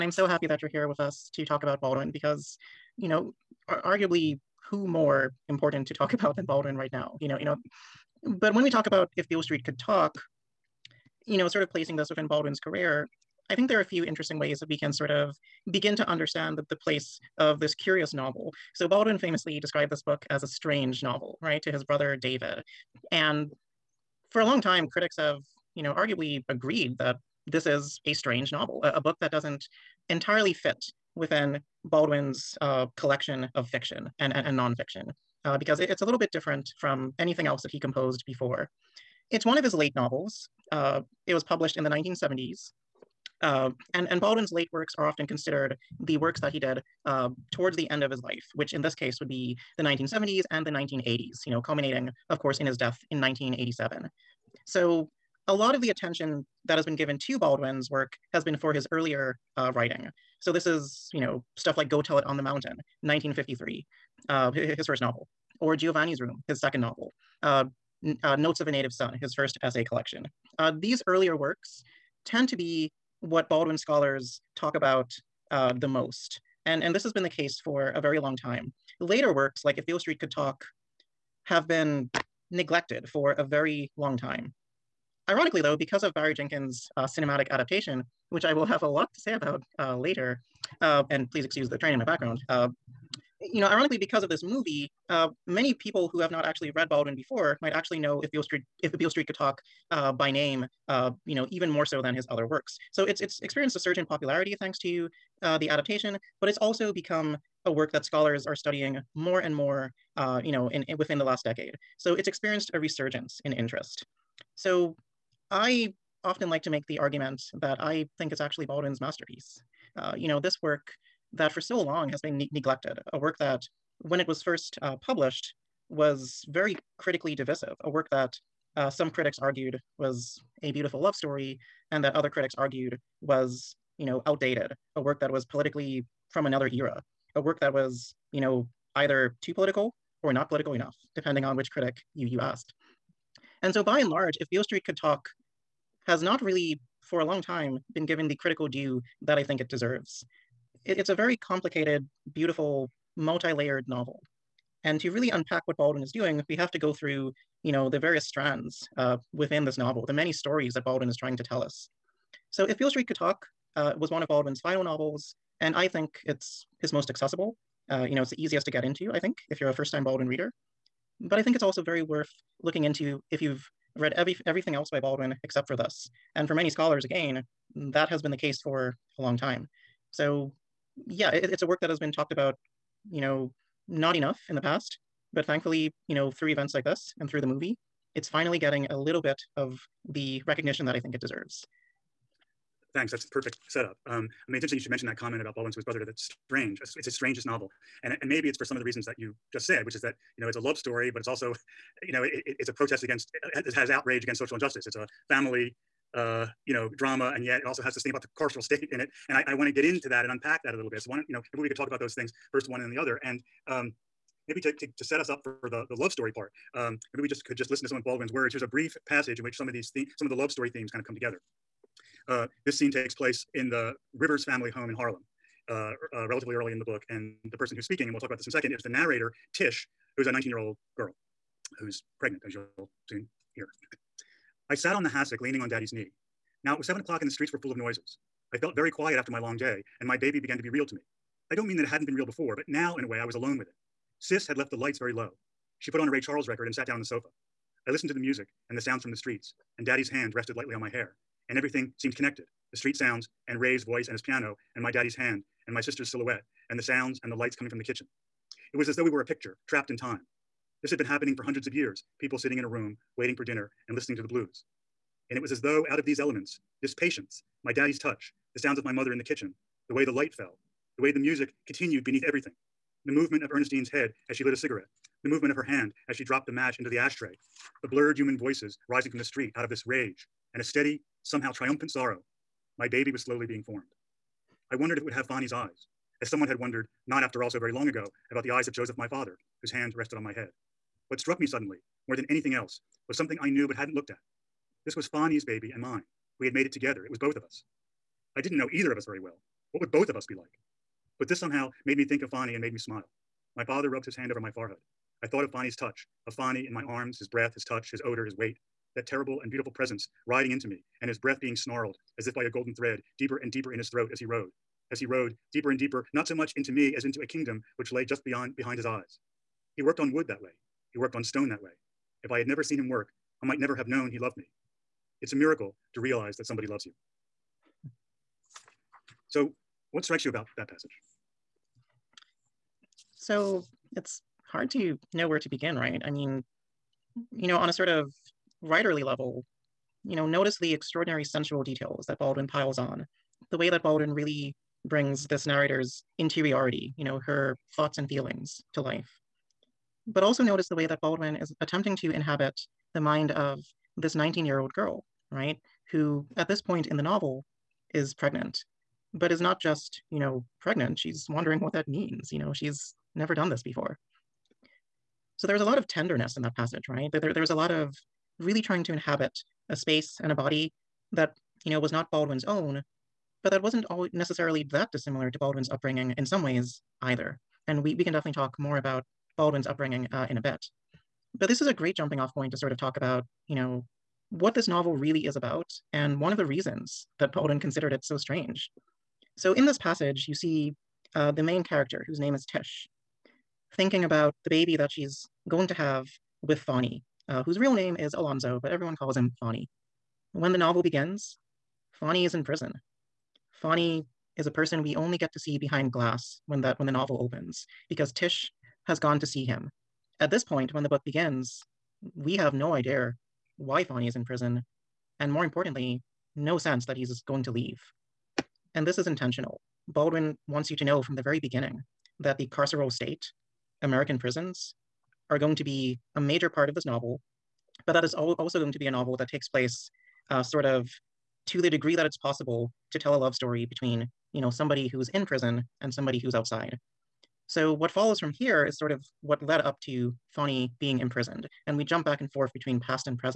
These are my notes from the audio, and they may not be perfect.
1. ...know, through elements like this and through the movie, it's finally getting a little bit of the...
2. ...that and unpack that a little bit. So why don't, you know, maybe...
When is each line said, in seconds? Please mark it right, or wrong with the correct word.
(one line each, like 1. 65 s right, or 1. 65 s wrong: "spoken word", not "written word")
1. 186 s wrong: "events", not "elements"
2. 210 s right.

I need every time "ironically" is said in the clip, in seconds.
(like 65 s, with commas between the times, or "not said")
85 s, 93 s.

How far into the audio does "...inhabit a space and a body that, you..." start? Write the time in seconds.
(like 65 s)
368 s.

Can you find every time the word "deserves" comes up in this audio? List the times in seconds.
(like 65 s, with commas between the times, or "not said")
149 s, 191 s.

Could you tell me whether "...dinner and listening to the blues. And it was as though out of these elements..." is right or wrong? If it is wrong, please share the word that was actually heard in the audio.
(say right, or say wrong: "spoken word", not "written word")
right.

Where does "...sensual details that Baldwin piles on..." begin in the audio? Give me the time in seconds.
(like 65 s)
341 s.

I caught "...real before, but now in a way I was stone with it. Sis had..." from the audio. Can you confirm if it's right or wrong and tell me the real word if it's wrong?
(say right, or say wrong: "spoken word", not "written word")
wrong: "alone", not "stone".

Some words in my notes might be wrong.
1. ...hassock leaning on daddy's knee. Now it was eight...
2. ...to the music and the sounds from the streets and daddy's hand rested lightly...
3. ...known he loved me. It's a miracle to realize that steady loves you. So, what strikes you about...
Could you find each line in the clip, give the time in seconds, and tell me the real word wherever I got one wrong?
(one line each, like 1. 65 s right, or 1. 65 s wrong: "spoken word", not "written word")
1. 235 s wrong: "seven", not "eight"
2. 248 s right
3. 323 s wrong: "somebody", not "steady".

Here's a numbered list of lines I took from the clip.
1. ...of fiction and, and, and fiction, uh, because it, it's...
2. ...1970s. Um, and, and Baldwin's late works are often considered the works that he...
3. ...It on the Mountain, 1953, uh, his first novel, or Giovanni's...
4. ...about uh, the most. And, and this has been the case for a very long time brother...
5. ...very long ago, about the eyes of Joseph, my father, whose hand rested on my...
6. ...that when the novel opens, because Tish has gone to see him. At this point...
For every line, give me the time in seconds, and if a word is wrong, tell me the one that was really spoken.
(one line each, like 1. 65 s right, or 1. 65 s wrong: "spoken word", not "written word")
1. 33 s wrong: "nonfiction", not "fiction"
2. 41 s right
3. 62 s right
4. 74 s wrong: "later", not "brother"
5. 287 s right
6. 406 s right.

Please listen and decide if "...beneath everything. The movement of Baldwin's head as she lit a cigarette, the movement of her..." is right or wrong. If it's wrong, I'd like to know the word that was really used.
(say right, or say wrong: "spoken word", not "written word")
wrong: "Ernestine", not "Baldwin".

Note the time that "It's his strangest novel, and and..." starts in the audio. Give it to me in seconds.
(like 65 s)
196 s.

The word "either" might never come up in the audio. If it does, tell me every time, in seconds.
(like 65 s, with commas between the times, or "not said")
138 s, 298 s, 377 s.